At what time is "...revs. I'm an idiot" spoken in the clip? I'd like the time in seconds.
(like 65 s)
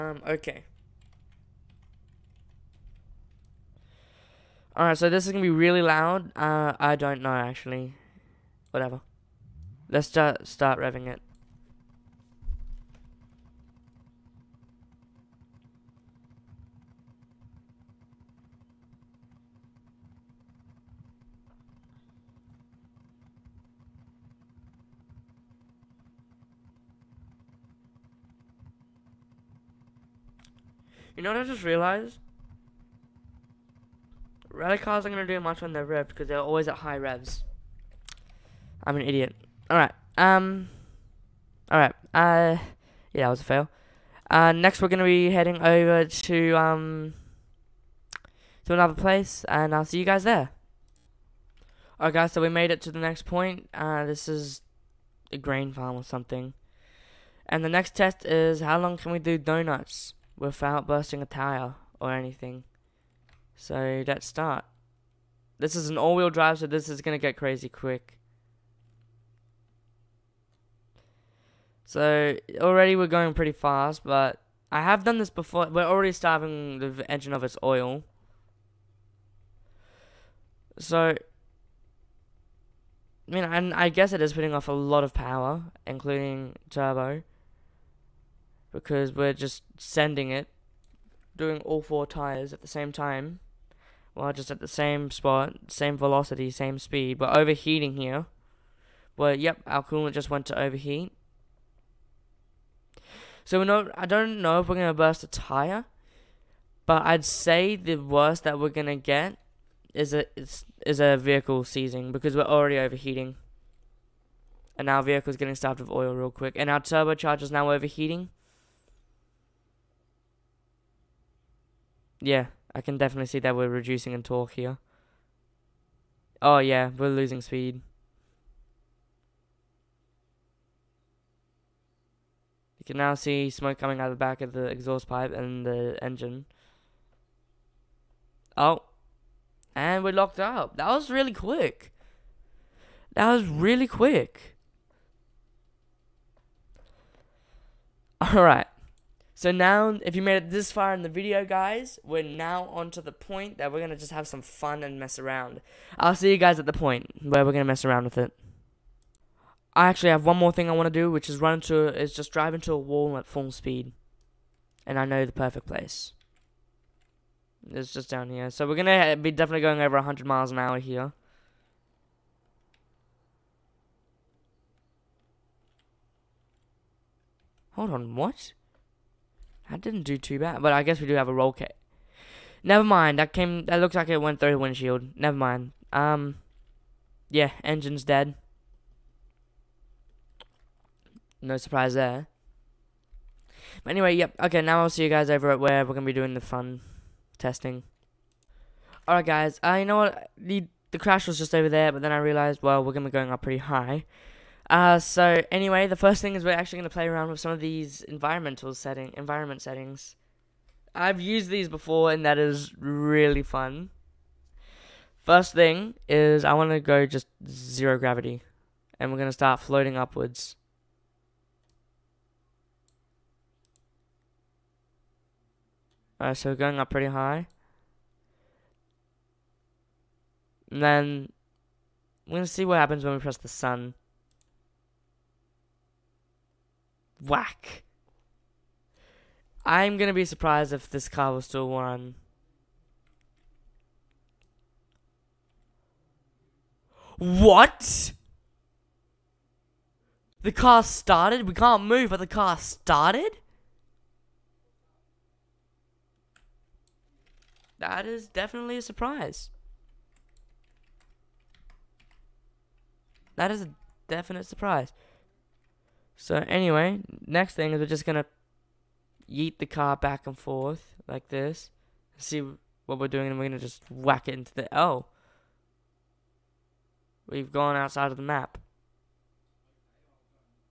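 36 s.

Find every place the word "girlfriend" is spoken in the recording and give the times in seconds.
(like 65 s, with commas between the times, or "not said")
not said.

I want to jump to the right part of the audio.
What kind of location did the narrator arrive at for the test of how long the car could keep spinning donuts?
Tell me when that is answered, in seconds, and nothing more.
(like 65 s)
55 s.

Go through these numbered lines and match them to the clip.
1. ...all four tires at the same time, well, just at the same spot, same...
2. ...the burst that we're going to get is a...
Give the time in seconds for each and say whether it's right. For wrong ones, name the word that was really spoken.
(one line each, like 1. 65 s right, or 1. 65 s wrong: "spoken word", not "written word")
1. 91 s right
2. 107 s wrong: "worst", not "burst".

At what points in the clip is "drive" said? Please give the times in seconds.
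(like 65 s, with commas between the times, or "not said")
66 s, 162 s.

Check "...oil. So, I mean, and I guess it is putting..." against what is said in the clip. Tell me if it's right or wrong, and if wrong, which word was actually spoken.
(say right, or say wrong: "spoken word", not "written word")
right.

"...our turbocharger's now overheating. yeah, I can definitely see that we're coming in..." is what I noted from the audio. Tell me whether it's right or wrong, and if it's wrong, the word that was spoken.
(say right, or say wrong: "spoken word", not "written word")
wrong: "reducing", not "coming".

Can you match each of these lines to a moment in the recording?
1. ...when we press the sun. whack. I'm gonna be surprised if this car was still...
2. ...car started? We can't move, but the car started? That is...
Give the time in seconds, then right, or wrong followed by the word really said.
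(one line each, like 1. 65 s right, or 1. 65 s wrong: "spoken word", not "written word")
1. 233 s right
2. 250 s right.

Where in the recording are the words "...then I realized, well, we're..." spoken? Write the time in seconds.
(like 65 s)
202 s.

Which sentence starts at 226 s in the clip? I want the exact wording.
Alright, so we're going up pretty high.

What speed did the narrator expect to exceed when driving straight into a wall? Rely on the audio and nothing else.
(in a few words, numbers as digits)
100 miles an hour.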